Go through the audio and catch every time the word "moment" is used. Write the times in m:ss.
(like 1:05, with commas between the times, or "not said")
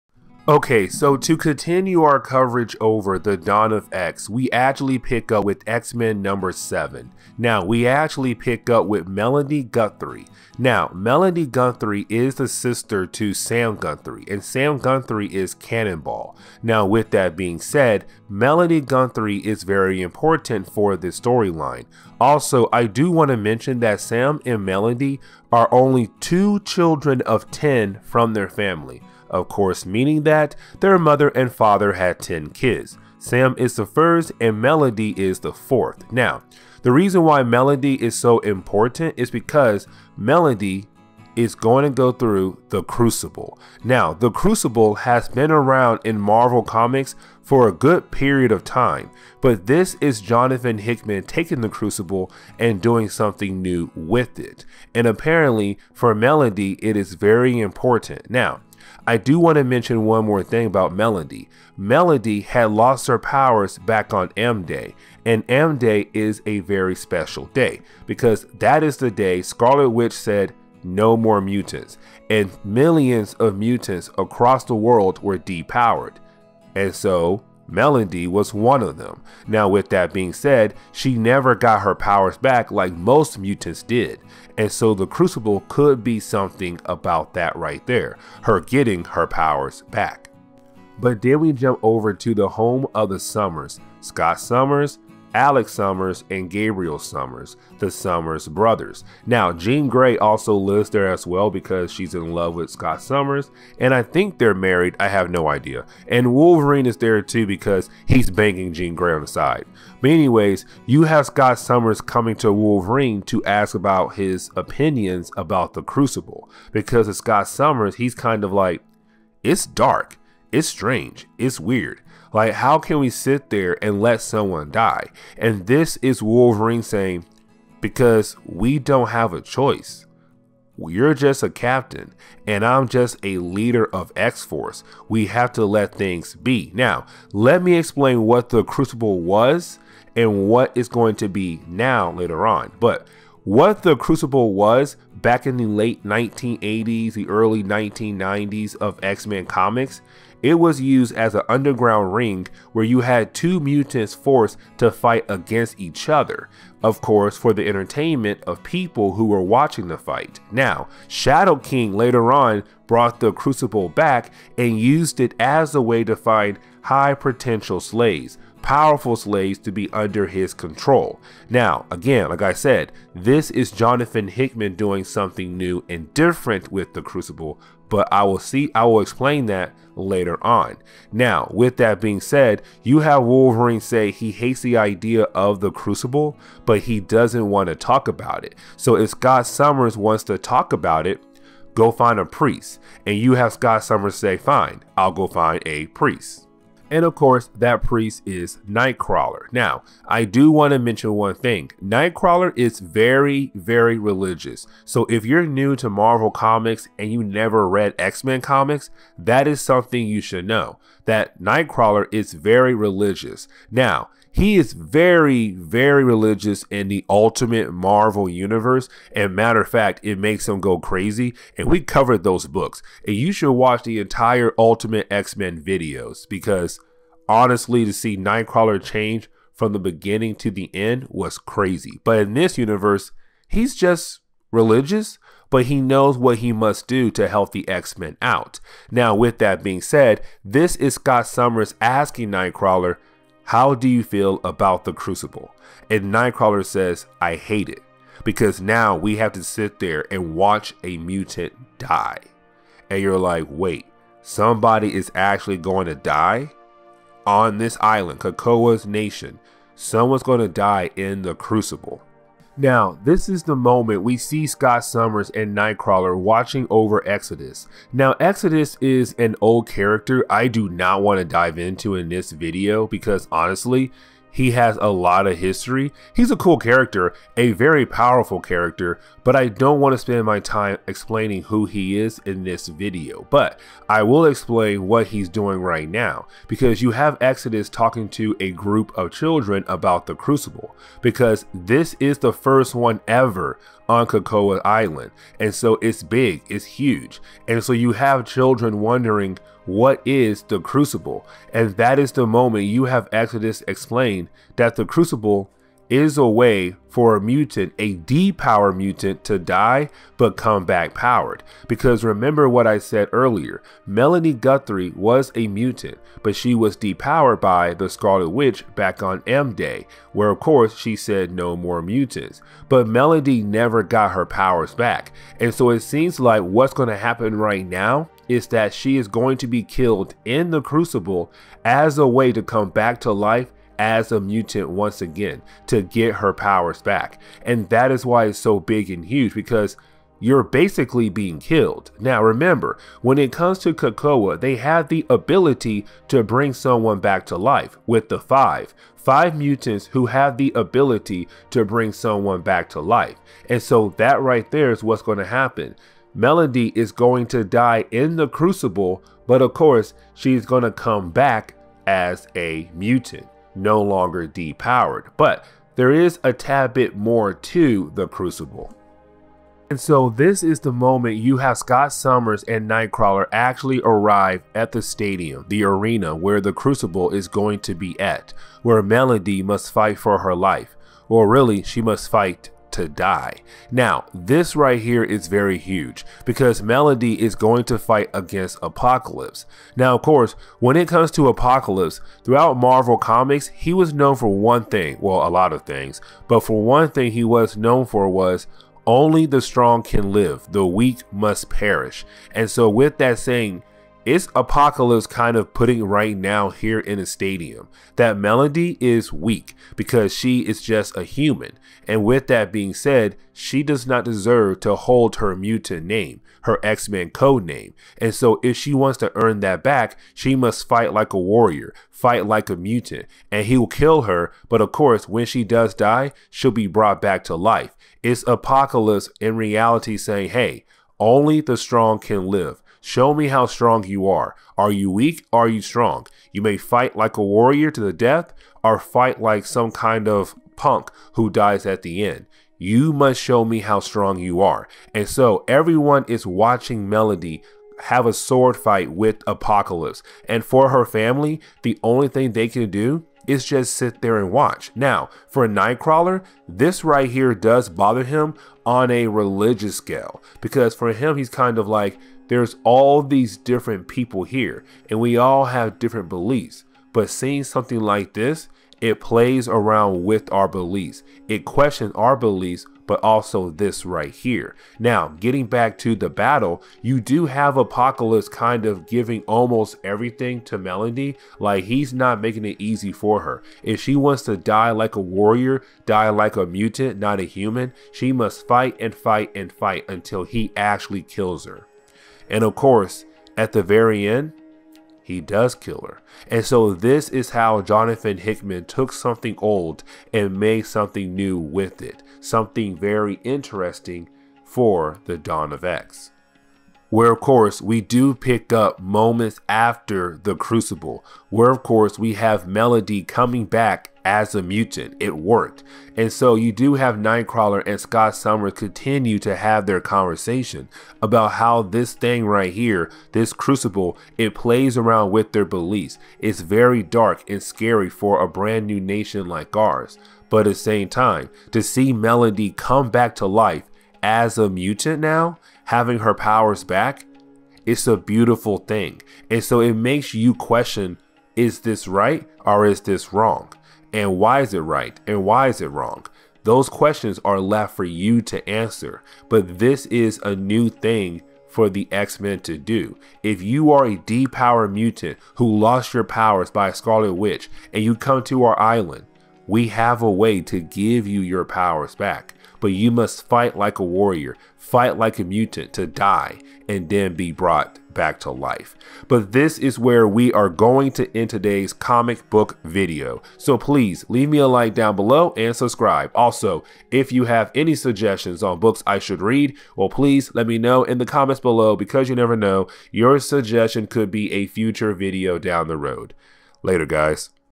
4:23, 5:02, 6:10, 8:28.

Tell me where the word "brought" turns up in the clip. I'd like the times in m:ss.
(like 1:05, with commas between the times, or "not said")
2:42, 7:06, 9:27.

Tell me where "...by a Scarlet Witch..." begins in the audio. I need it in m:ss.
9:16.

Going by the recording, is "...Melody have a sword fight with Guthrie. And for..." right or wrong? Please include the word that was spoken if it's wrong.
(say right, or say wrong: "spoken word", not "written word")
wrong: "Apocalypse", not "Guthrie".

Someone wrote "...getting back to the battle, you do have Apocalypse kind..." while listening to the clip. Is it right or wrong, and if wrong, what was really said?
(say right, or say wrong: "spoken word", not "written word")
right.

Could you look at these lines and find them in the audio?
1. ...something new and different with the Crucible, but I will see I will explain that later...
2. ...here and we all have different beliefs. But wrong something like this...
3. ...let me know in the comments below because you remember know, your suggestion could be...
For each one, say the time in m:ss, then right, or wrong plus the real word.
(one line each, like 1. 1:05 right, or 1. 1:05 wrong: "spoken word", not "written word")
1. 2:55 right
2. 7:44 wrong: "seeing", not "wrong"
3. 9:40 wrong: "never", not "remember".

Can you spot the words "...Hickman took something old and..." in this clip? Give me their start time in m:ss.
8:18.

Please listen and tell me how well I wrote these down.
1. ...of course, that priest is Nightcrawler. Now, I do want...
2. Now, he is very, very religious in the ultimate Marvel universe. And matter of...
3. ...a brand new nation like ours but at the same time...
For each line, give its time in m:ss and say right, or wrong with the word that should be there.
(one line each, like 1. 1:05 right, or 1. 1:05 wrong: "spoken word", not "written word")
1. 3:17 right
2. 3:33 right
3. 8:48 right.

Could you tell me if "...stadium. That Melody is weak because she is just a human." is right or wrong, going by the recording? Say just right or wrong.
right.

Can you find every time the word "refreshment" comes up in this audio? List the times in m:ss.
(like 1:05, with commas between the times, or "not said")
not said.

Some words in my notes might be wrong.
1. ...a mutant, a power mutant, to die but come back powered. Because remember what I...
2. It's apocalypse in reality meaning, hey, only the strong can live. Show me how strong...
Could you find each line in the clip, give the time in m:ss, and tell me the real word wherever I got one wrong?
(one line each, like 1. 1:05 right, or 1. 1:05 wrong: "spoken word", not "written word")
1. 5:07 right
2. 7:08 wrong: "saying", not "meaning".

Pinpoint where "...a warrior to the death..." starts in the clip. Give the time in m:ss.
7:17.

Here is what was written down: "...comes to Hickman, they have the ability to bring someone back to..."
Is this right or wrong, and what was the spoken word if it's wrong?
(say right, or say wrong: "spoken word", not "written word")
wrong: "Krakoa", not "Hickman".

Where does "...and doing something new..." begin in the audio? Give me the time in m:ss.
0:52.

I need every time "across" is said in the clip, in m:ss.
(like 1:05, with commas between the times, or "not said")
1:14.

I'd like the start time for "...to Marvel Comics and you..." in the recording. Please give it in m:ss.
3:25.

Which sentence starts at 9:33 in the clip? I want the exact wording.
So please leave me a like down below and subscribe.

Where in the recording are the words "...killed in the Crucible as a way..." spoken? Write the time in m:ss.
5:29.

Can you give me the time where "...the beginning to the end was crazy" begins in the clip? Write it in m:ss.
3:49.